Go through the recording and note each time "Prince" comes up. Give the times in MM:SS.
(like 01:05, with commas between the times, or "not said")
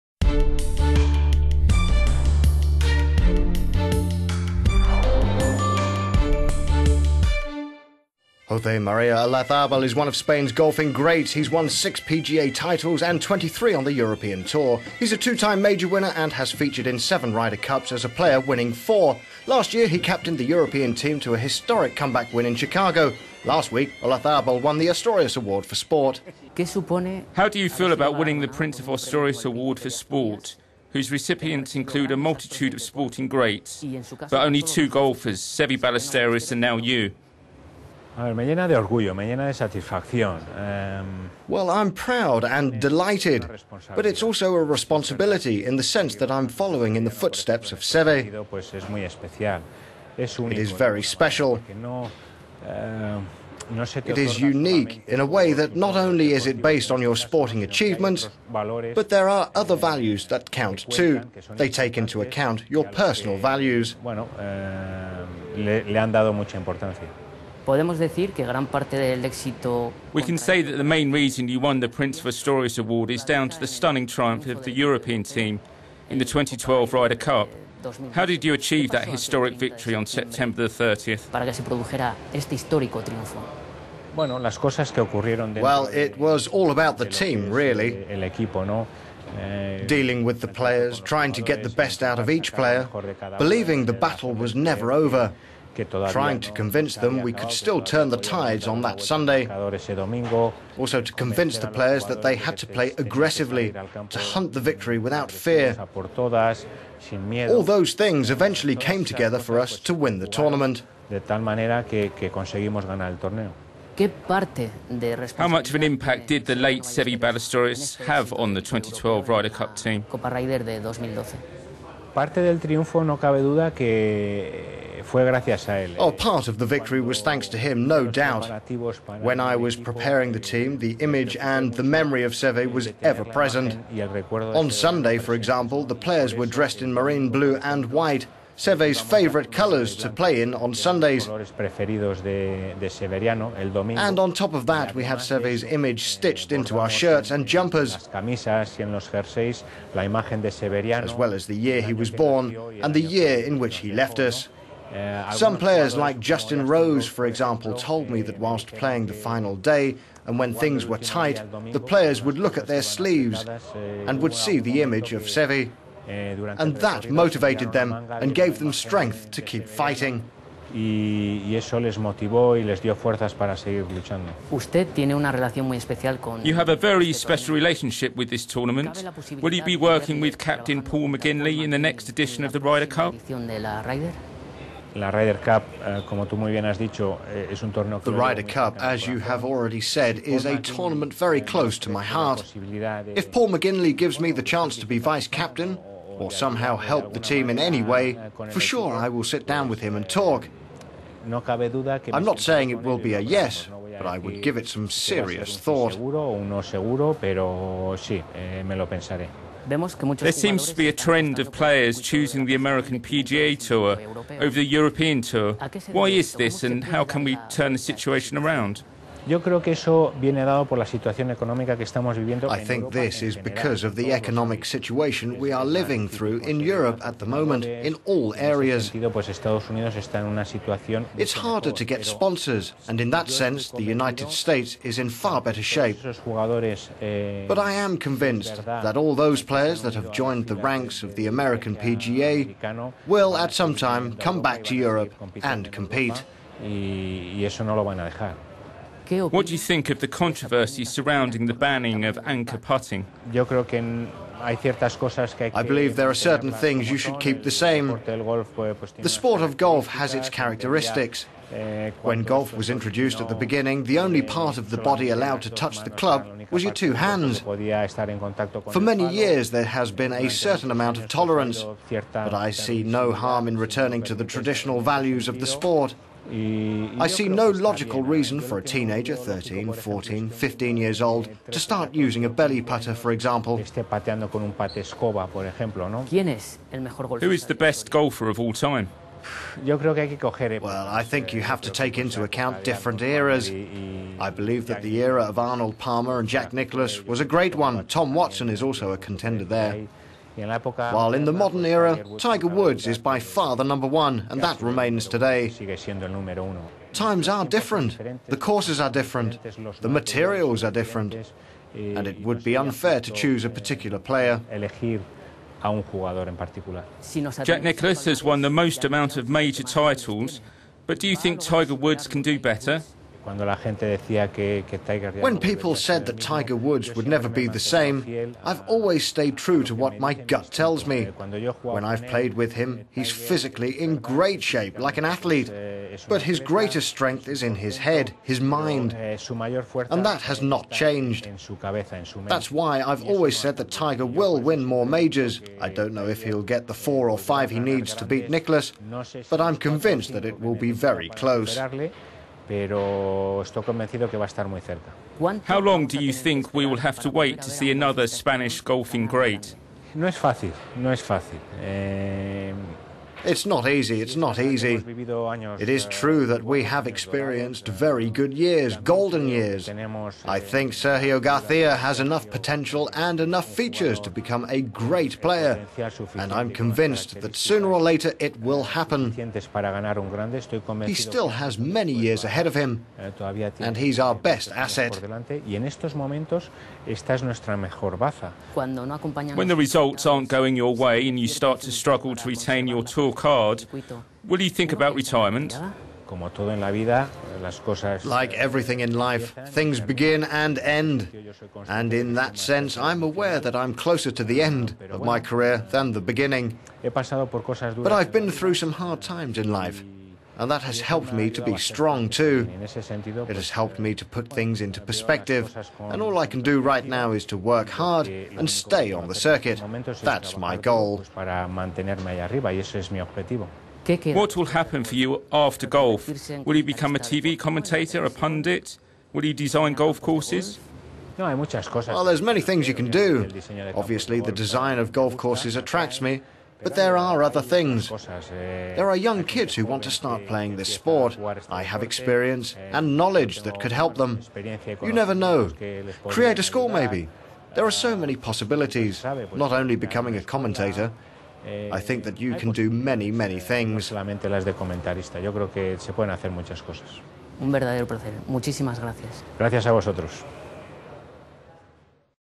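00:28, 01:11.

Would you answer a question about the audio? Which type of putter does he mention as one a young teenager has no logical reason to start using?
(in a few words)
belly putter.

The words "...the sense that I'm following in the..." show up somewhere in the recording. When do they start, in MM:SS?
00:45.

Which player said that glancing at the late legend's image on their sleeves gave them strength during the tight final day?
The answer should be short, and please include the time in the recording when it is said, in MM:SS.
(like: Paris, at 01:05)
Justin Rose, at 02:36.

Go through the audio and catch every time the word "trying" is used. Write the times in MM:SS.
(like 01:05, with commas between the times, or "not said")
01:30, 01:36.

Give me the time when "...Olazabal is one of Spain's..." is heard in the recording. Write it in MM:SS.
00:09.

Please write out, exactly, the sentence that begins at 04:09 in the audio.
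What do you think of the controversy surrounding the banning of anchor putting?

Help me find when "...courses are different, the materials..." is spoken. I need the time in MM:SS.
05:08.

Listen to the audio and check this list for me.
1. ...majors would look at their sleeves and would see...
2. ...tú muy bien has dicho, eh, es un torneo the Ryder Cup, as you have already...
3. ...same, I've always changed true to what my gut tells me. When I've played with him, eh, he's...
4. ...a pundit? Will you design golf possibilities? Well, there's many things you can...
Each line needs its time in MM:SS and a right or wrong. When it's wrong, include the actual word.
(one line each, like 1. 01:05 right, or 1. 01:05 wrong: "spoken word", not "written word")
1. 02:41 wrong: "players", not "majors"
2. 03:06 right
3. 05:27 wrong: "stayed", not "changed"
4. 07:08 wrong: "courses", not "possibilities".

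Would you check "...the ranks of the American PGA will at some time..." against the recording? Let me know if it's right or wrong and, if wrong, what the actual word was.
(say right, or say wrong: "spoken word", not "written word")
right.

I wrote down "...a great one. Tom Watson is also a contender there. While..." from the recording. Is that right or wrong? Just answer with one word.
right.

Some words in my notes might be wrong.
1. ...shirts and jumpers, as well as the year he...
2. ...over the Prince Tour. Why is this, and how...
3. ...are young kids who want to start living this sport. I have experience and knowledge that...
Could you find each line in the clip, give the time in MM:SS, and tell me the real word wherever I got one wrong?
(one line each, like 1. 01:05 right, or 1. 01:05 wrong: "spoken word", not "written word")
1. 02:26 right
2. 03:34 wrong: "European", not "Prince"
3. 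07:18 wrong: "playing", not "living".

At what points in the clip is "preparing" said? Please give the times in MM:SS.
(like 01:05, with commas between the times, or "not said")
02:09.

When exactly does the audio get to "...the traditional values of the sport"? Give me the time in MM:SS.
04:34.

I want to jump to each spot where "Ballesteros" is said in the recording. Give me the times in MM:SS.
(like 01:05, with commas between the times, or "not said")
00:35, 01:57.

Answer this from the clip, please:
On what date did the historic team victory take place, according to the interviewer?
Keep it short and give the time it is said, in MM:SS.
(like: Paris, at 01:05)
September 30, at 01:20.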